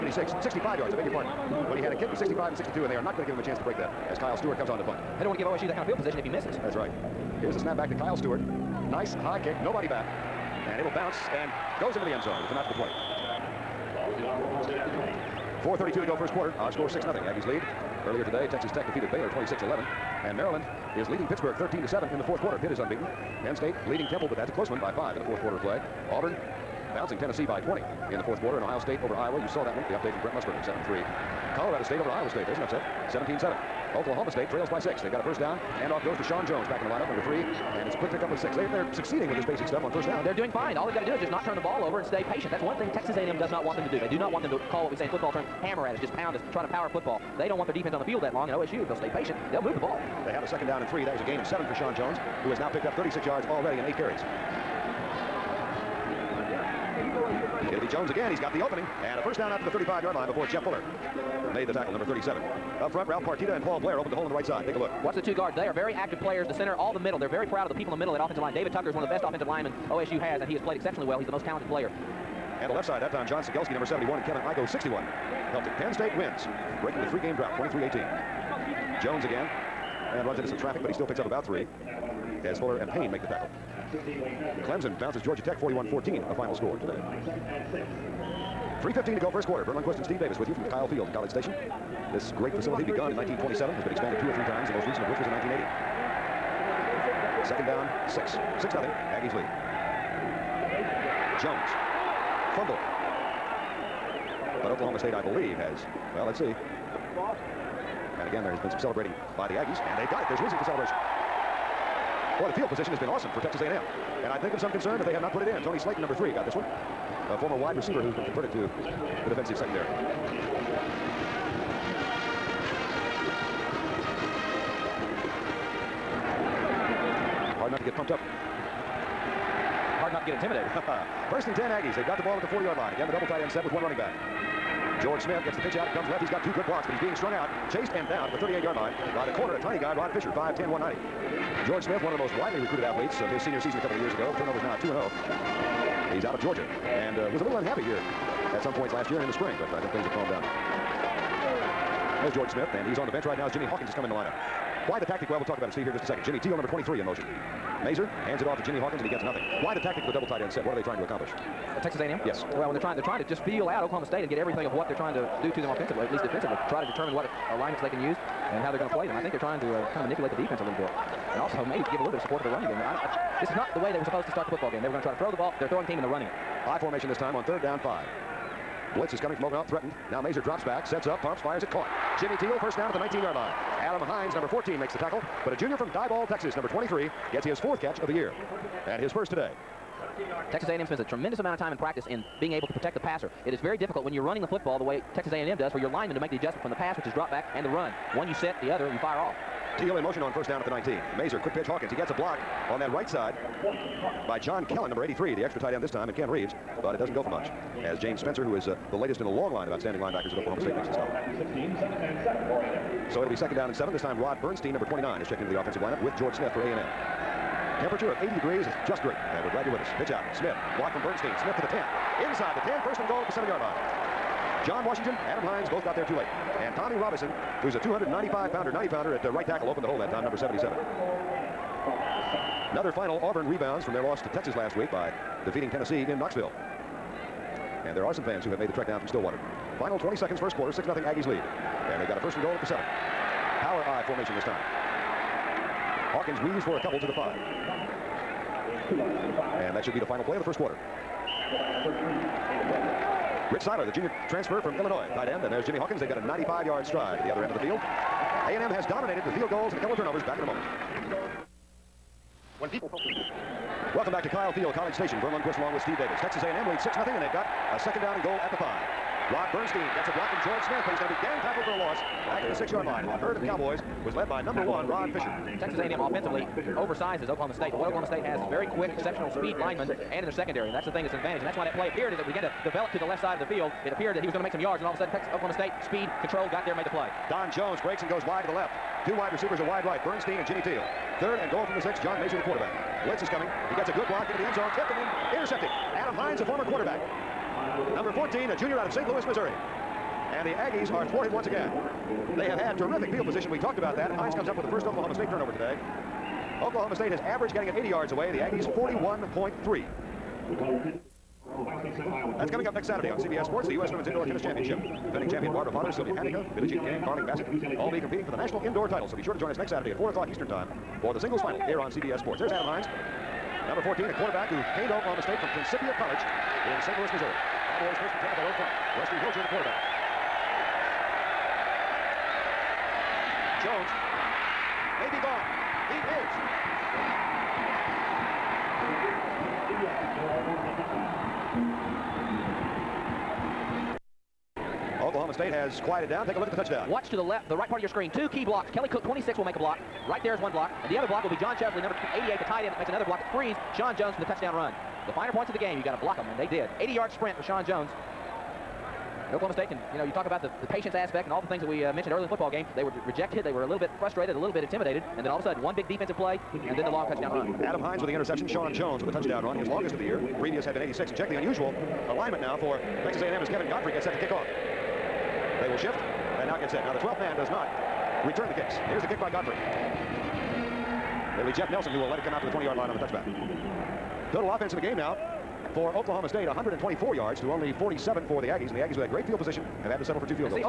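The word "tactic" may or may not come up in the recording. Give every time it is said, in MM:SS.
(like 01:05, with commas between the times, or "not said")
02:35, 02:39.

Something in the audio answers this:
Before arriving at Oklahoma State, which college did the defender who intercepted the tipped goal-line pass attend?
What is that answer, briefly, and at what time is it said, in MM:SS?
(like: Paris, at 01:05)
Principia College, at 05:25.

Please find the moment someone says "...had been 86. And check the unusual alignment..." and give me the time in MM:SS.
06:10.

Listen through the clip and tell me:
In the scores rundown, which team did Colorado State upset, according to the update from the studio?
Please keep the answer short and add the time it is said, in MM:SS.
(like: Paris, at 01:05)
Iowa State, at 00:31.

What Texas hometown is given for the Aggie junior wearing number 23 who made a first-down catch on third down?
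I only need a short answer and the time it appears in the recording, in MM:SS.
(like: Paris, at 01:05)
Diboll, Texas, at 03:05.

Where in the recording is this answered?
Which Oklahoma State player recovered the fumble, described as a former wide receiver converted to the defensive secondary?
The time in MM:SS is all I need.
01:55.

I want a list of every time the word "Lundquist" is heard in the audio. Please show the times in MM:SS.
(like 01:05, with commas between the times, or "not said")
01:29, 04:25.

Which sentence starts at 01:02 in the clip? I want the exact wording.
Up front, Ralph Partita and Paul Blair opened the hole on the right side.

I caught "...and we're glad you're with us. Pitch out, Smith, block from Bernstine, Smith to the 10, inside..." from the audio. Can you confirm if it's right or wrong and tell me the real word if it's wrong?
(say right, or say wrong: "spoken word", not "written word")
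right.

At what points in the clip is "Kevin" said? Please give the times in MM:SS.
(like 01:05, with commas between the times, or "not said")
01:14, 06:13.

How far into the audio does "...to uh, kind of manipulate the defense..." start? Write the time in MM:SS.
02:49.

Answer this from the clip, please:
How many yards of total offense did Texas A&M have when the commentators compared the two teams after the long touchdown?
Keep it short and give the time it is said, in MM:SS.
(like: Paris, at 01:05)
47, at 06:27.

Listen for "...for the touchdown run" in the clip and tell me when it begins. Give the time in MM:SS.
05:54.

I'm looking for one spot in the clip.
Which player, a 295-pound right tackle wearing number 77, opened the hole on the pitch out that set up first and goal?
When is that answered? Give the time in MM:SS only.
03:46.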